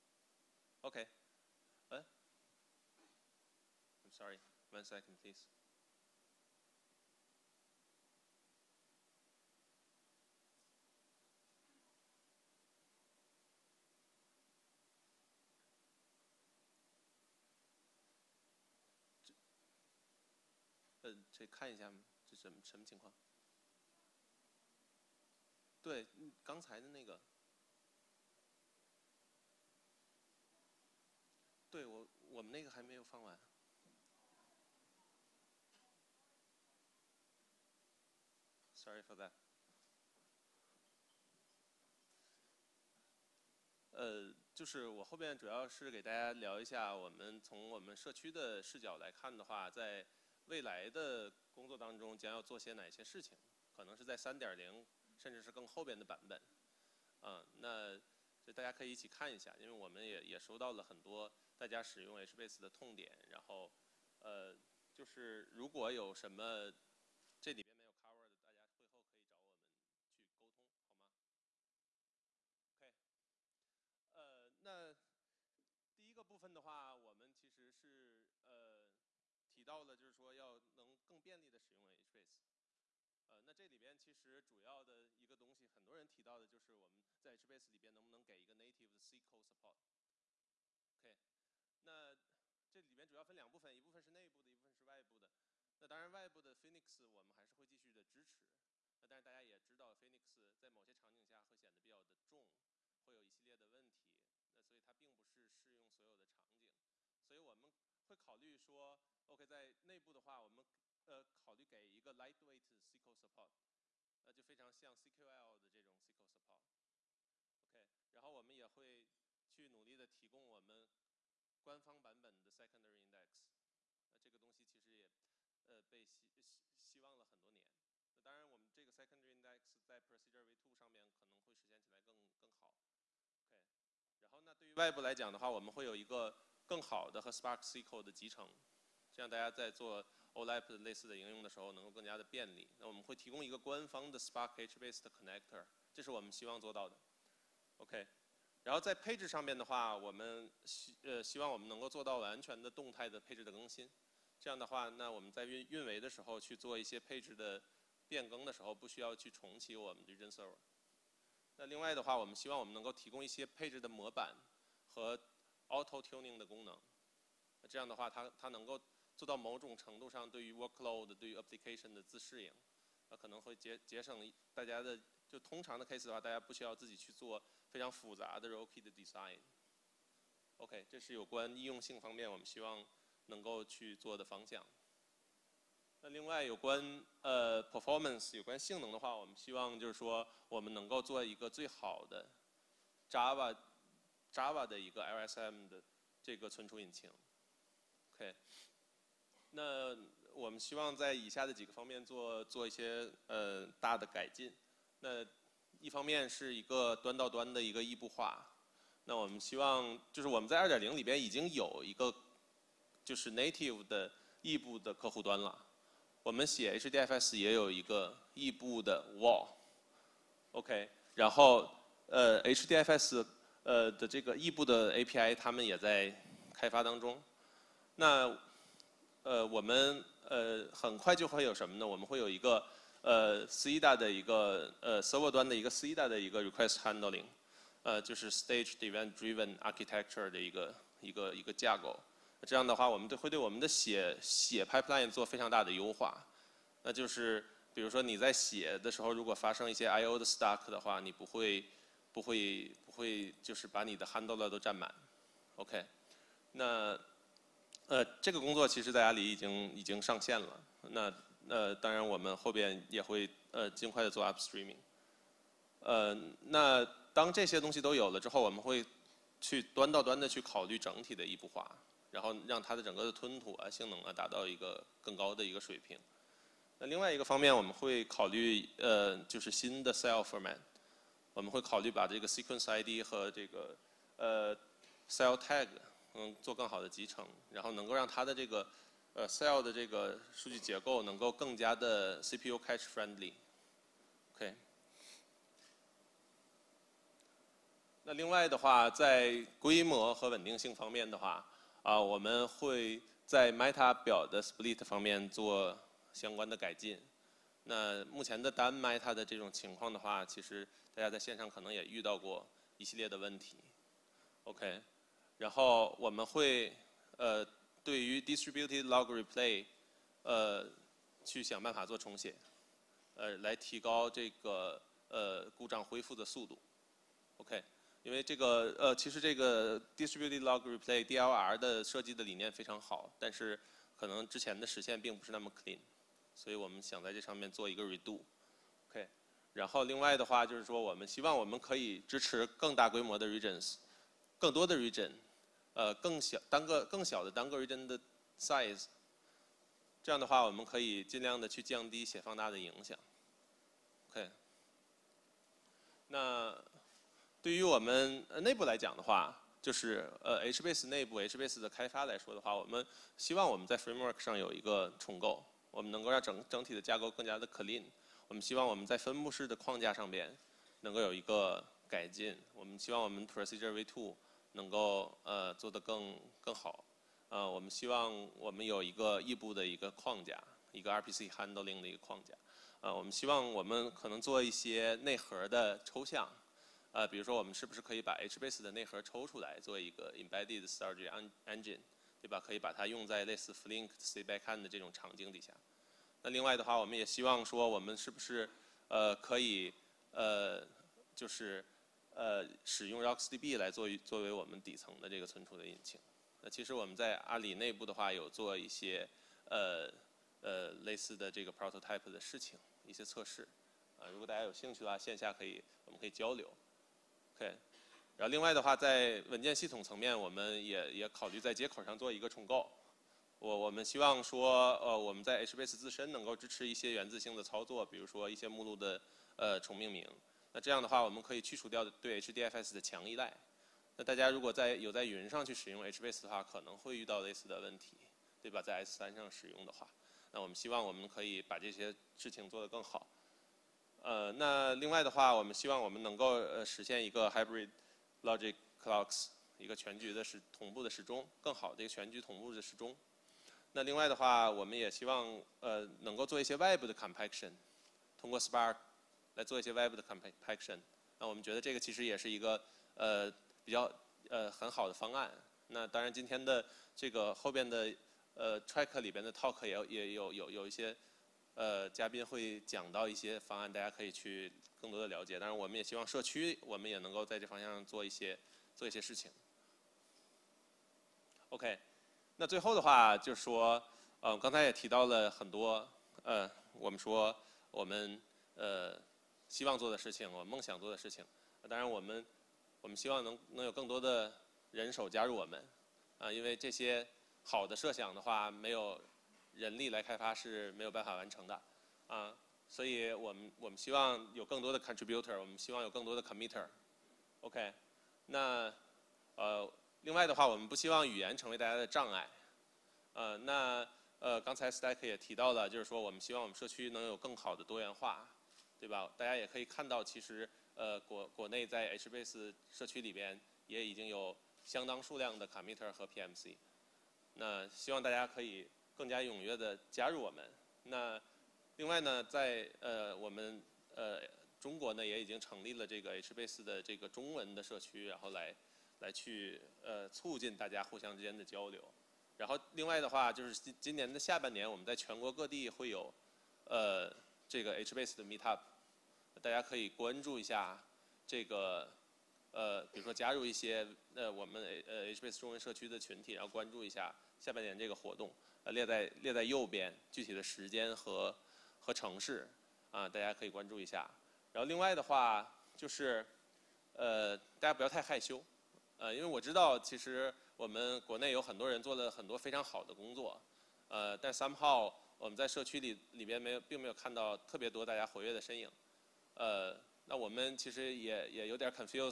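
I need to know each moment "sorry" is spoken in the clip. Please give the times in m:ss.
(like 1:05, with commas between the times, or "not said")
0:04, 0:38.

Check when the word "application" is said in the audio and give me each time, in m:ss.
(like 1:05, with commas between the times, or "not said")
2:51.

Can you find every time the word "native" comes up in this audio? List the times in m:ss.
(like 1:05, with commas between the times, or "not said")
1:28, 3:33.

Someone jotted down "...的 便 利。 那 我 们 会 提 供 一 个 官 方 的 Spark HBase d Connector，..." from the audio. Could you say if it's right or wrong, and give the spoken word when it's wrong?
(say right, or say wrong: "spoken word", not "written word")
right.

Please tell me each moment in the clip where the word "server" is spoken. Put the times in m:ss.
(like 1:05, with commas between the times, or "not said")
2:40, 3:55.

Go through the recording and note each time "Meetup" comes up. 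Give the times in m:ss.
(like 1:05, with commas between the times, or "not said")
9:08.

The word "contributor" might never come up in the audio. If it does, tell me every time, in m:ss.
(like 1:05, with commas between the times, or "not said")
8:24.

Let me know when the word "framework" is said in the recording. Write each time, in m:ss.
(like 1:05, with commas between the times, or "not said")
6:03.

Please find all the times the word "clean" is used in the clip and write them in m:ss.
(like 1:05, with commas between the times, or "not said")
5:35, 6:07.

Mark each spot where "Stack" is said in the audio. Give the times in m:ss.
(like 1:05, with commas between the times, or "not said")
8:34.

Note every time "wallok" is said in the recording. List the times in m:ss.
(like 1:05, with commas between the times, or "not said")
3:40.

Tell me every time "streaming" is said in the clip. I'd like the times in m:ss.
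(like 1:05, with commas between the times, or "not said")
4:24.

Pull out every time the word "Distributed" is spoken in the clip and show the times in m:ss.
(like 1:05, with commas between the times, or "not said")
5:18, 5:29.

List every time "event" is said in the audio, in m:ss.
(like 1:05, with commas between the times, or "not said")
3:58.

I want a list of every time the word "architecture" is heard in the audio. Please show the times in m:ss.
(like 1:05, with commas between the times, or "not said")
3:59.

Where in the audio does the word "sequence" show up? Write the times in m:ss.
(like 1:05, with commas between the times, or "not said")
4:42.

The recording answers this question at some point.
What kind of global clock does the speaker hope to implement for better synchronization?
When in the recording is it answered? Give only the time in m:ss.
7:27.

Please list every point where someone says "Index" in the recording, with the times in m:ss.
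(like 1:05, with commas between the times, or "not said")
2:03, 2:09.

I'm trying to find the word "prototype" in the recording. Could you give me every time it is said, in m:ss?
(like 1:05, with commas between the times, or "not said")
6:51.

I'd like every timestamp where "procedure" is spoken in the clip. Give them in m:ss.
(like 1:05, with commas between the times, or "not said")
2:10, 6:13.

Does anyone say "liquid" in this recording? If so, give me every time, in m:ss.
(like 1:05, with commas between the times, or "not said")
not said.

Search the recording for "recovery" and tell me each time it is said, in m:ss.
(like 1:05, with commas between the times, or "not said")
not said.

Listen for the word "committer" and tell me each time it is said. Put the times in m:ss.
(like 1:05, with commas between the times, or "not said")
8:26, 8:45.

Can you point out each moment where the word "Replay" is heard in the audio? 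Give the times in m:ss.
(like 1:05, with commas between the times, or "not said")
5:19, 5:30.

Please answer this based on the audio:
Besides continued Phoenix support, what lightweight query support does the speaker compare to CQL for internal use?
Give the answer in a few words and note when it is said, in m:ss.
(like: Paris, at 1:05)
Lightweight SQL Support, at 1:52.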